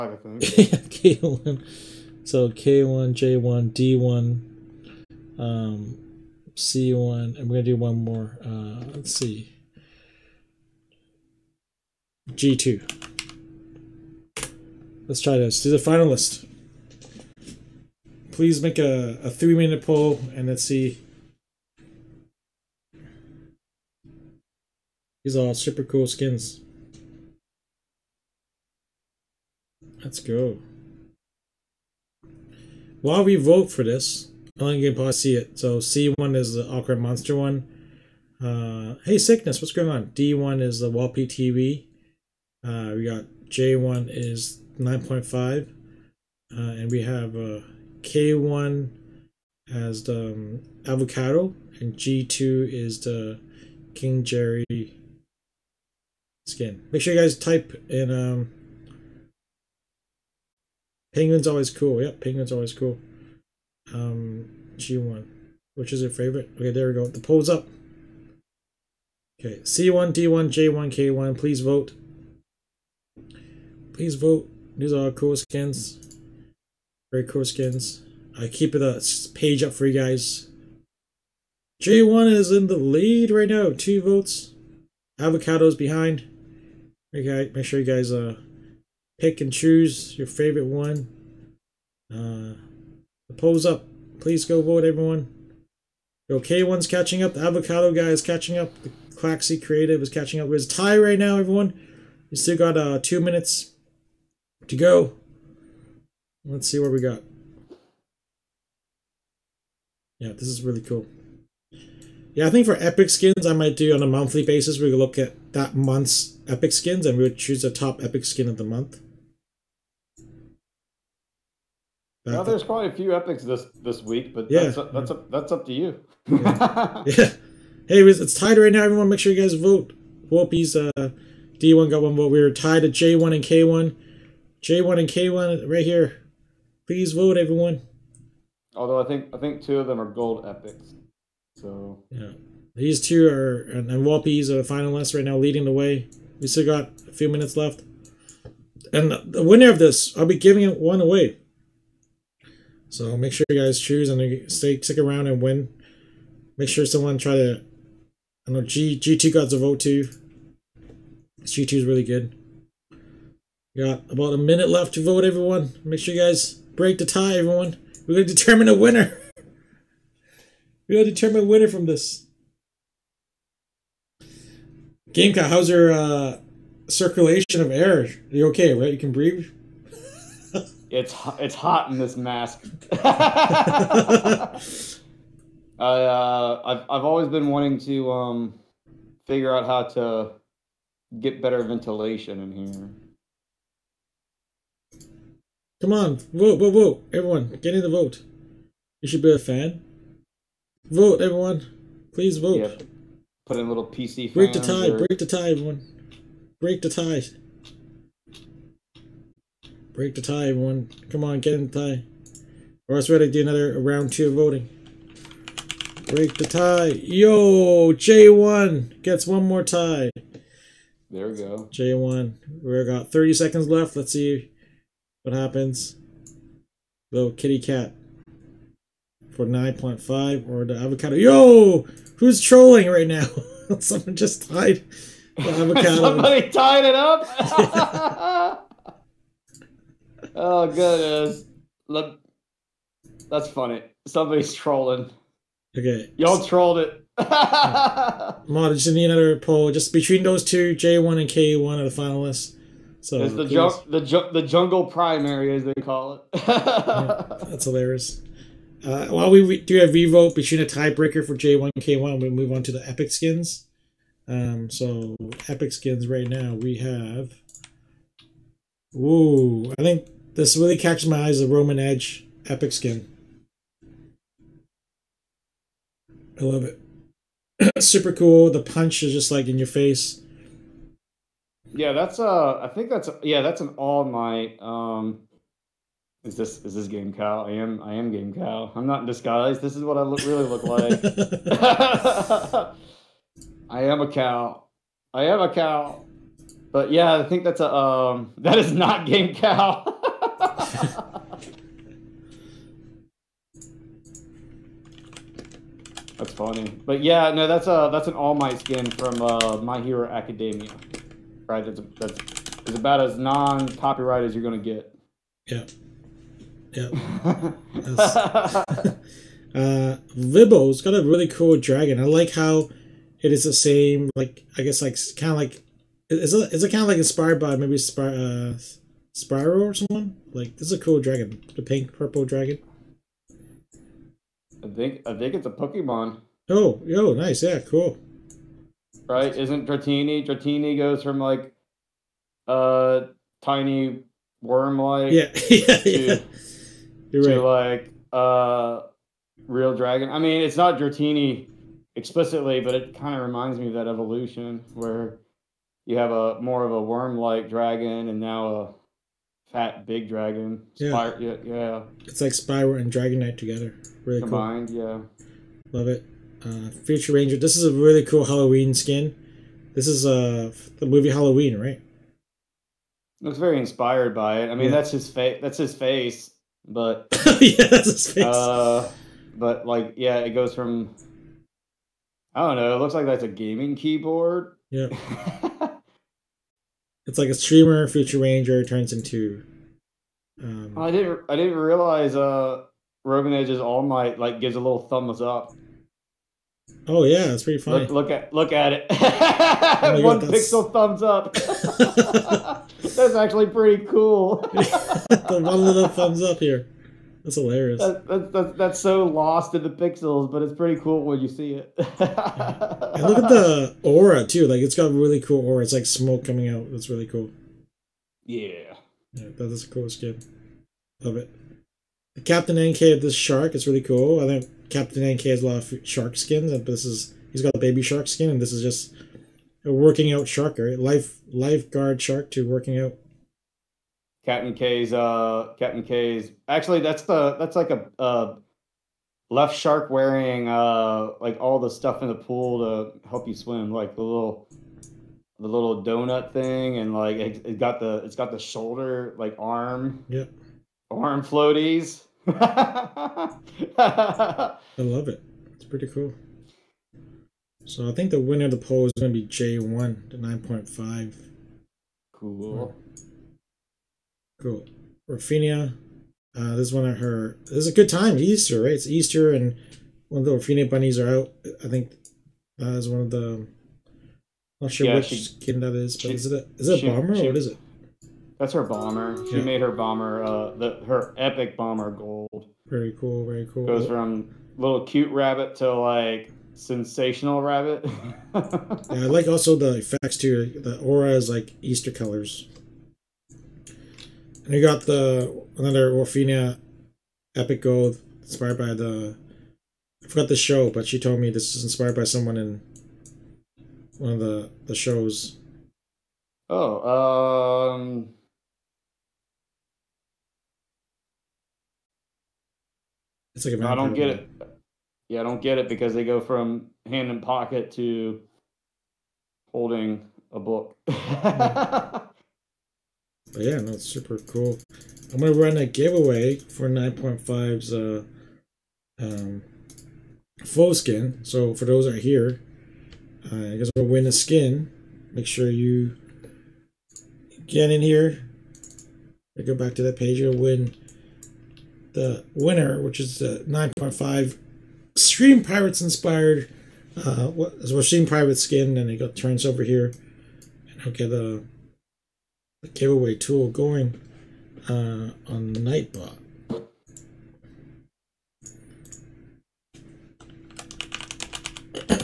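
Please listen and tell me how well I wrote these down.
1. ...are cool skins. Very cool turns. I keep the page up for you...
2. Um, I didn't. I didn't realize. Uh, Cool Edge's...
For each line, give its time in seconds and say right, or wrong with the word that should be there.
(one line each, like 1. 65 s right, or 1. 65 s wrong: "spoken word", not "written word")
1. 74 s wrong: "skins", not "turns"
2. 390 s wrong: "Roman", not "Cool".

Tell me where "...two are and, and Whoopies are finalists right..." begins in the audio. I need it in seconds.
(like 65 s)
142 s.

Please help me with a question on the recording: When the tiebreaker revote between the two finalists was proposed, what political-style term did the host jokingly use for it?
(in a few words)
Jungle primary.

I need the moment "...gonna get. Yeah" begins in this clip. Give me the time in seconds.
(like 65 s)
314 s.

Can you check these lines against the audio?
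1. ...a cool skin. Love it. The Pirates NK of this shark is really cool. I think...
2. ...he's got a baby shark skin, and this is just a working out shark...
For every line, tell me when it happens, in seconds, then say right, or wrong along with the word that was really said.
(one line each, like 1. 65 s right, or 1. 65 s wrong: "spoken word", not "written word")
1. 419 s wrong: "Captain", not "Pirates"
2. 427 s right.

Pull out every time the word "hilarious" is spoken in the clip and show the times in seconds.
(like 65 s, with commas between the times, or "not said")
257 s, 407 s.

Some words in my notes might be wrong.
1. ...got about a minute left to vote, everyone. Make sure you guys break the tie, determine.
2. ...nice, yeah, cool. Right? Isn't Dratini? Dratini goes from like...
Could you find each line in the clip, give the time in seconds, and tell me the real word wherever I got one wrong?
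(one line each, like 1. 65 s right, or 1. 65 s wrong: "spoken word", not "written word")
1. 163 s wrong: "everyone", not "determine"
2. 337 s right.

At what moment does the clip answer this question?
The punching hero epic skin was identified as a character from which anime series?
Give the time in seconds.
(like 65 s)
309 s.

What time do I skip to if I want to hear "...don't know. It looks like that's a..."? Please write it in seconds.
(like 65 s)
382 s.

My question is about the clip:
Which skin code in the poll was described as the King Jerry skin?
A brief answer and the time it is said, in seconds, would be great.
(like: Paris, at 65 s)
G2, at 51 s.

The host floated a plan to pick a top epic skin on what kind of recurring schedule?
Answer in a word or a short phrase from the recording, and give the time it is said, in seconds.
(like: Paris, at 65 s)
Monthly, at 114 s.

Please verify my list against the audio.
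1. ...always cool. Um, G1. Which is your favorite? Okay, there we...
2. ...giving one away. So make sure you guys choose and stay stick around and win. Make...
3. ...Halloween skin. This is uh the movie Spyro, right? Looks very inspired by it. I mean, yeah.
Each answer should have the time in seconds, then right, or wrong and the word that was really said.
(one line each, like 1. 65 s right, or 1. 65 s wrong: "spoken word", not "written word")
1. 62 s right
2. 150 s right
3. 368 s wrong: "Halloween", not "Spyro".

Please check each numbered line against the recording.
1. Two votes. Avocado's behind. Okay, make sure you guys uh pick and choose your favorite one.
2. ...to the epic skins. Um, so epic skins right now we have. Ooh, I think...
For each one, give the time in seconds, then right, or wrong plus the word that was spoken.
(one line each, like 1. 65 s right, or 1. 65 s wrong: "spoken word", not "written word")
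1. 83 s right
2. 262 s right.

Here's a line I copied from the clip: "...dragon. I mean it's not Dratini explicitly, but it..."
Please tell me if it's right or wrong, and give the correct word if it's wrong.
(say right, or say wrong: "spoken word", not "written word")
right.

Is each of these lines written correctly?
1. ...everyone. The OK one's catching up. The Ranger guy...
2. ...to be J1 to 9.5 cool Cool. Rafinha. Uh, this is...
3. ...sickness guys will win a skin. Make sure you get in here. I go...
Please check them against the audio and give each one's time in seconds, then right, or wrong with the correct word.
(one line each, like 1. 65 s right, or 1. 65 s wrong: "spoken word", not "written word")
1. 94 s wrong: "Avocado", not "Ranger"
2. 459 s right
3. 533 s wrong: "guess", not "sickness".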